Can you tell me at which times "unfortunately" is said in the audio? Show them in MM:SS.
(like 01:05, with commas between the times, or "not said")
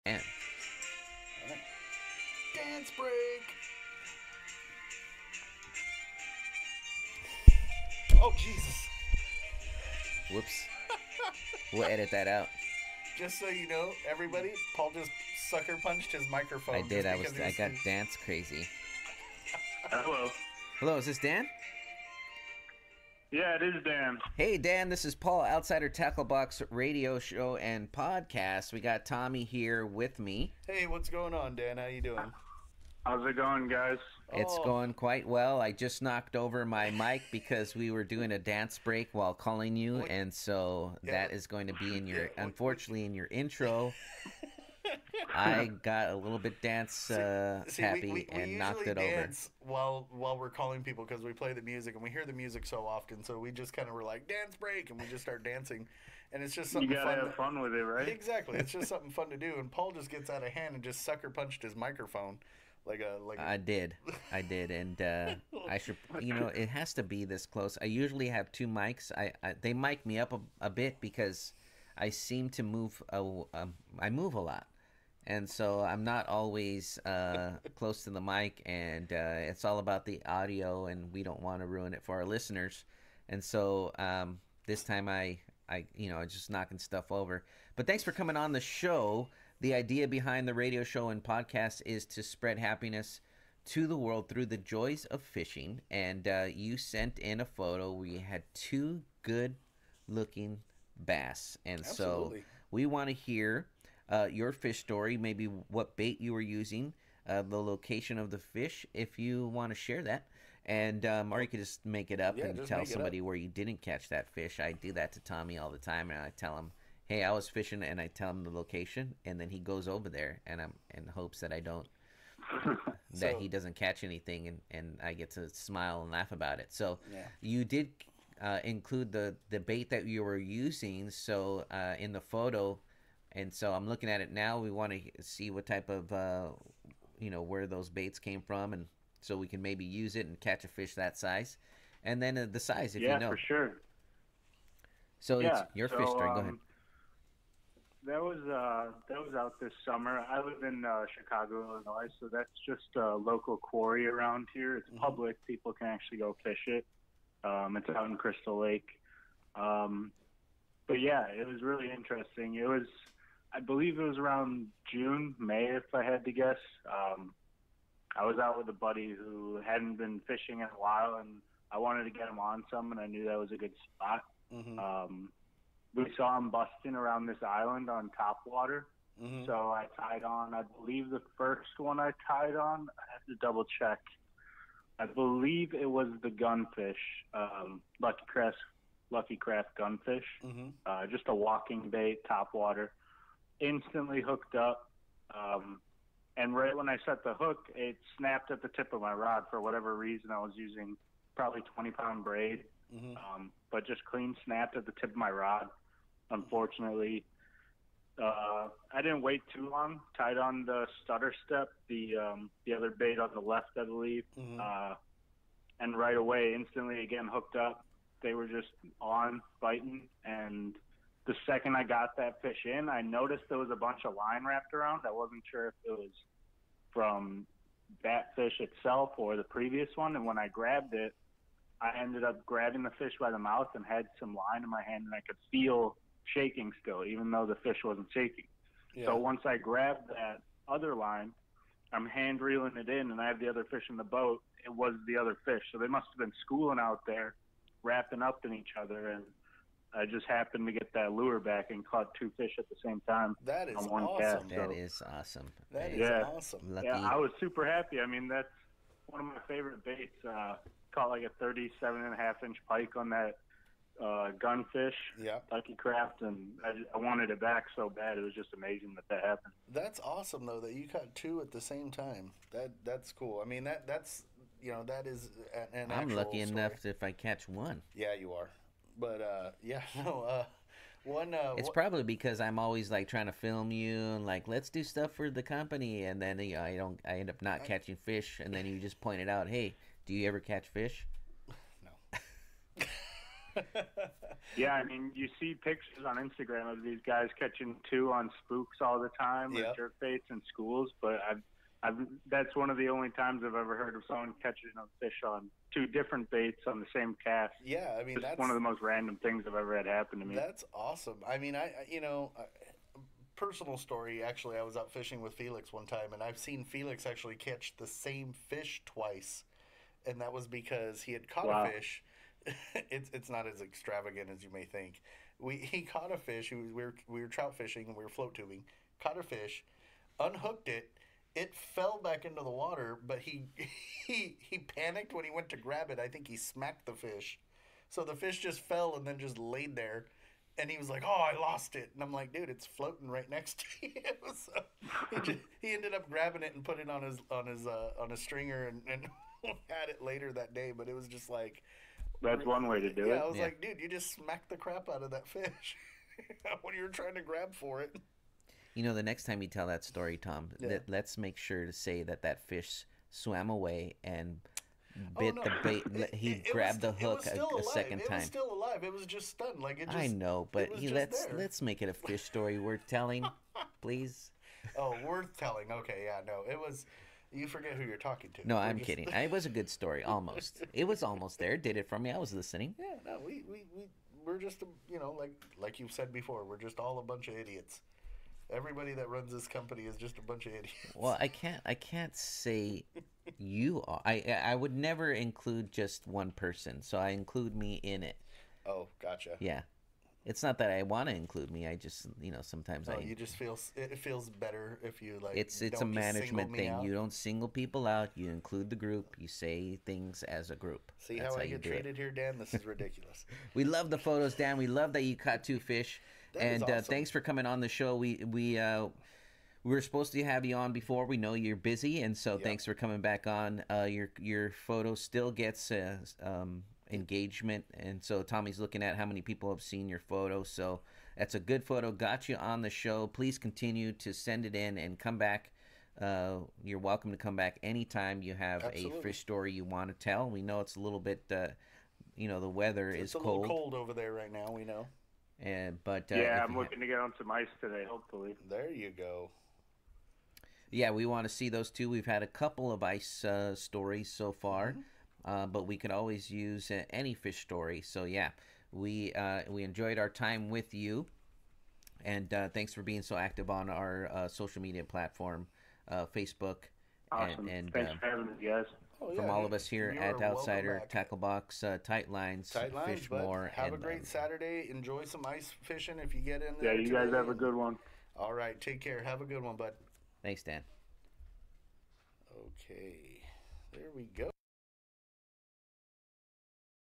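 00:42, 03:26.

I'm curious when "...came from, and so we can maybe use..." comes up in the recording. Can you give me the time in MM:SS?
02:18.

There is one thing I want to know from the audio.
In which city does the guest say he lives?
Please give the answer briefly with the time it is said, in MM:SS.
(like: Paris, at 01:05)
Chicago, at 02:31.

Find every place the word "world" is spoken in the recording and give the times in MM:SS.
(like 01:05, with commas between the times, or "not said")
01:33.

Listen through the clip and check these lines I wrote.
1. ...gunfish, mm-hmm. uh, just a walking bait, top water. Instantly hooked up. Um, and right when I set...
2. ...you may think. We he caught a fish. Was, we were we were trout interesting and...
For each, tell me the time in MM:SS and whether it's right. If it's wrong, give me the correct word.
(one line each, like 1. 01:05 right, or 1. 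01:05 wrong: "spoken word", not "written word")
1. 03:09 right
2. 05:24 wrong: "fishing", not "interesting".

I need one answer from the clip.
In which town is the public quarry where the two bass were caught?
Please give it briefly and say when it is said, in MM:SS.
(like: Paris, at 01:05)
Crystal Lake, at 02:38.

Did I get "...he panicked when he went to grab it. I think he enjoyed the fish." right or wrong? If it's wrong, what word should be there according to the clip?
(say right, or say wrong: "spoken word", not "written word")
wrong: "smacked", not "enjoyed".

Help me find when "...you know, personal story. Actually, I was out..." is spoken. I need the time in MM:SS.
05:11.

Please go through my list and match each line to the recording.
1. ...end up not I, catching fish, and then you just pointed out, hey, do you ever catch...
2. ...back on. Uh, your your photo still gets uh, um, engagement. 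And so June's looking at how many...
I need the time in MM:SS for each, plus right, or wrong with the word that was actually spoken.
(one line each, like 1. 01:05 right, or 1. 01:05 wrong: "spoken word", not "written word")
1. 04:47 right
2. 07:02 wrong: "Tommy", not "June".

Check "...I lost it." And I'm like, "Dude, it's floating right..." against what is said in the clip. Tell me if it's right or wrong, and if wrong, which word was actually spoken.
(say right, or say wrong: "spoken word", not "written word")
right.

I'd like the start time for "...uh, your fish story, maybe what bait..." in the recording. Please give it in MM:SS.
01:44.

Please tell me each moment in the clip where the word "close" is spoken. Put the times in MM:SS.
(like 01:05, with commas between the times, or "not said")
01:07, 01:17.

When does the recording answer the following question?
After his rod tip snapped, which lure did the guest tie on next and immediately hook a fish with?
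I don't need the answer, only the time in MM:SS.
03:31.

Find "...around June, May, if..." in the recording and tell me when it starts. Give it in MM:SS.
02:44.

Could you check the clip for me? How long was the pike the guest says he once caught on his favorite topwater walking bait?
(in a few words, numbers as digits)
37 and a half inches.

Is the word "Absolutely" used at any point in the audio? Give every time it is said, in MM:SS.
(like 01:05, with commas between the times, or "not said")
01:41, 07:18.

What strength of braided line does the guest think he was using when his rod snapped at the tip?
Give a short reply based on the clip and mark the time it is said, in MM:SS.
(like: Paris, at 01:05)
20 pound, at 03:21.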